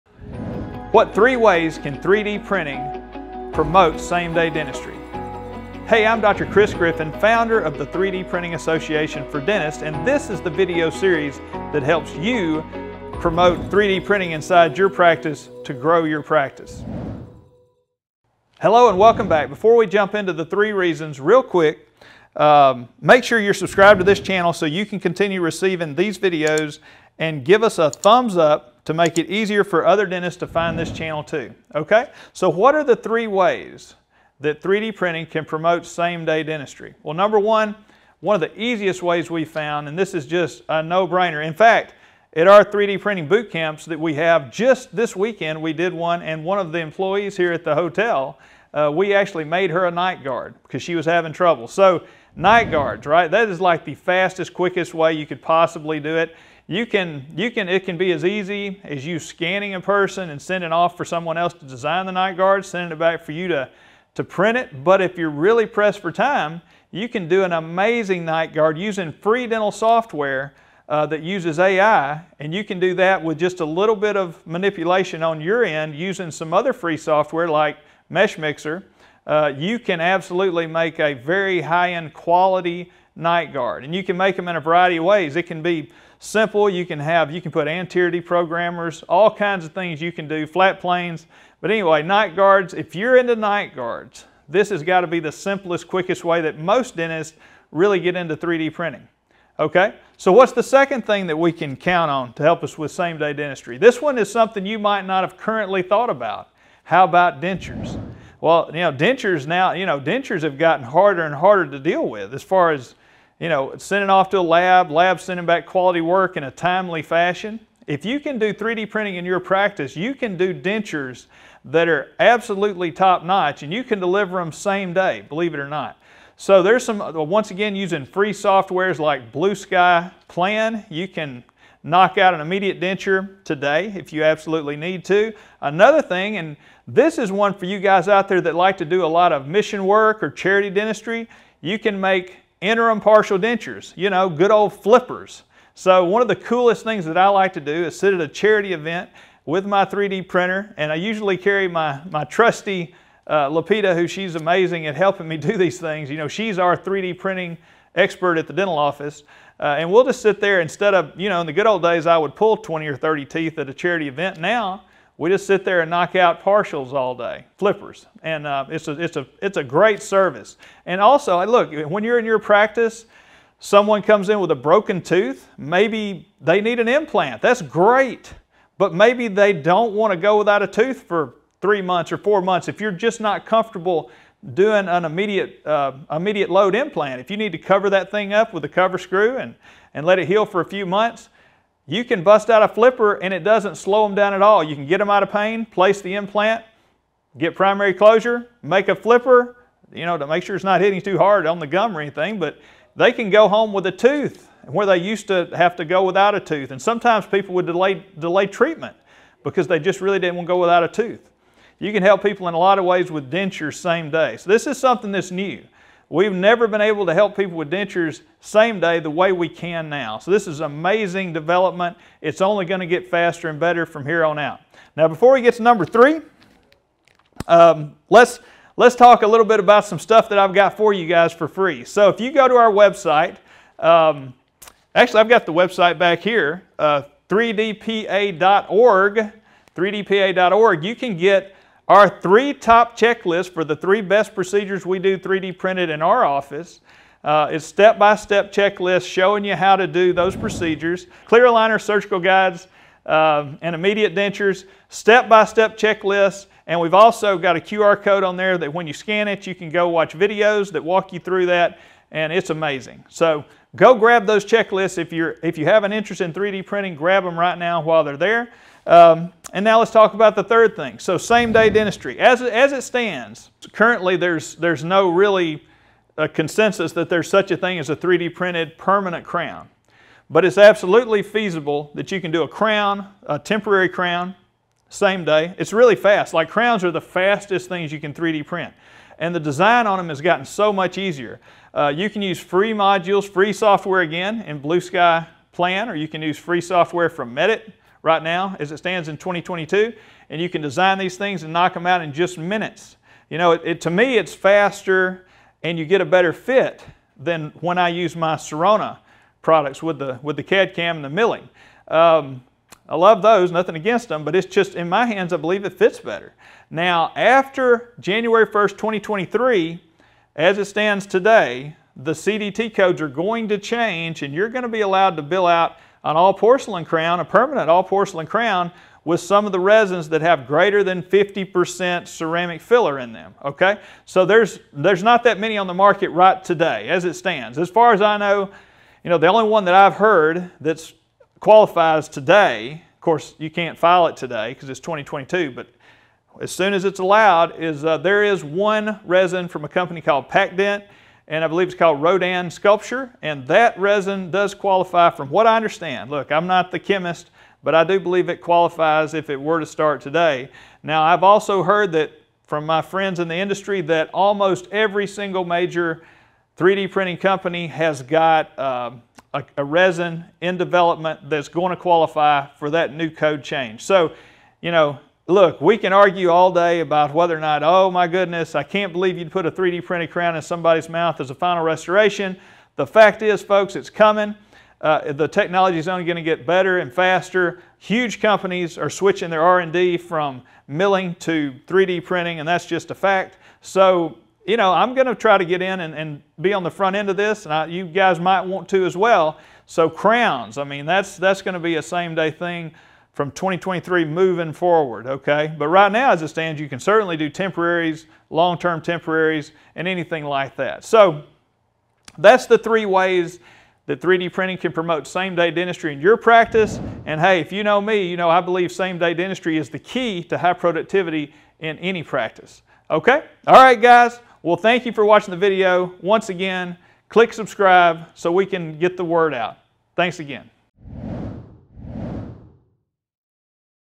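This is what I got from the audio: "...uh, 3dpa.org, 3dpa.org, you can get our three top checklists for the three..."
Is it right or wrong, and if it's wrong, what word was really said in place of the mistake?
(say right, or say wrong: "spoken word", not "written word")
right.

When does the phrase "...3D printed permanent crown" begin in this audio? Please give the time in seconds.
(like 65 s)
277 s.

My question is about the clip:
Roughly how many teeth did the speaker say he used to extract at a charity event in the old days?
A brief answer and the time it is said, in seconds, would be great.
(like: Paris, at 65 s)
20 or 30, at 162 s.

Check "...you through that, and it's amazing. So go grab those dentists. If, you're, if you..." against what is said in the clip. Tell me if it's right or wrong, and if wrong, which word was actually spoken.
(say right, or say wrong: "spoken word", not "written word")
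wrong: "checklists", not "dentists".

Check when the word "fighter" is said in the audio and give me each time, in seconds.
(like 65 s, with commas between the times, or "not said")
not said.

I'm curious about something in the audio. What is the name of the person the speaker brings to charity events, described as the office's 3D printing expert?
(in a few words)
Lapita.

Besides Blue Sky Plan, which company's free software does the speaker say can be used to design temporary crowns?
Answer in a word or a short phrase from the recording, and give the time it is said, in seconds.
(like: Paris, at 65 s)
Medit, at 297 s.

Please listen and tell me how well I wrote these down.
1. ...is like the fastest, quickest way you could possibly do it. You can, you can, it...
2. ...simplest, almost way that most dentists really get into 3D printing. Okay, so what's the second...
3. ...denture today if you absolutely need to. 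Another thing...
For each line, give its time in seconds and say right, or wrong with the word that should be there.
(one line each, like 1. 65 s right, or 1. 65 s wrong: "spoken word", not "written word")
1. 53 s right
2. 95 s wrong: "quickest", not "almost"
3. 132 s right.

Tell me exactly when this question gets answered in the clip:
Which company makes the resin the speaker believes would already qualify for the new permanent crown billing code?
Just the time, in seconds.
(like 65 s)
350 s.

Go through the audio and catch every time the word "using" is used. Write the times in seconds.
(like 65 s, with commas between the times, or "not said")
68 s, 75 s, 127 s.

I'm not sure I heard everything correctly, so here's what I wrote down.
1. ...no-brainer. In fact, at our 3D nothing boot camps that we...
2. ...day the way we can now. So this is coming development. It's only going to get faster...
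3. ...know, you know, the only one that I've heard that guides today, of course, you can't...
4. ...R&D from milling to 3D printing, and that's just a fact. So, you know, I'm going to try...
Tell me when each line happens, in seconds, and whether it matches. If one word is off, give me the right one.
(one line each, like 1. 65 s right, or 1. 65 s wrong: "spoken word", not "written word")
1. 40 s wrong: "printing", not "nothing"
2. 218 s wrong: "amazing", not "coming"
3. 338 s wrong: "qualifies", not "guides"
4. 389 s right.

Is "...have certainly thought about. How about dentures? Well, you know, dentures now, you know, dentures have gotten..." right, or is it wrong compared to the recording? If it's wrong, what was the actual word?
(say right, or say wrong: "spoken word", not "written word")
wrong: "currently", not "certainly".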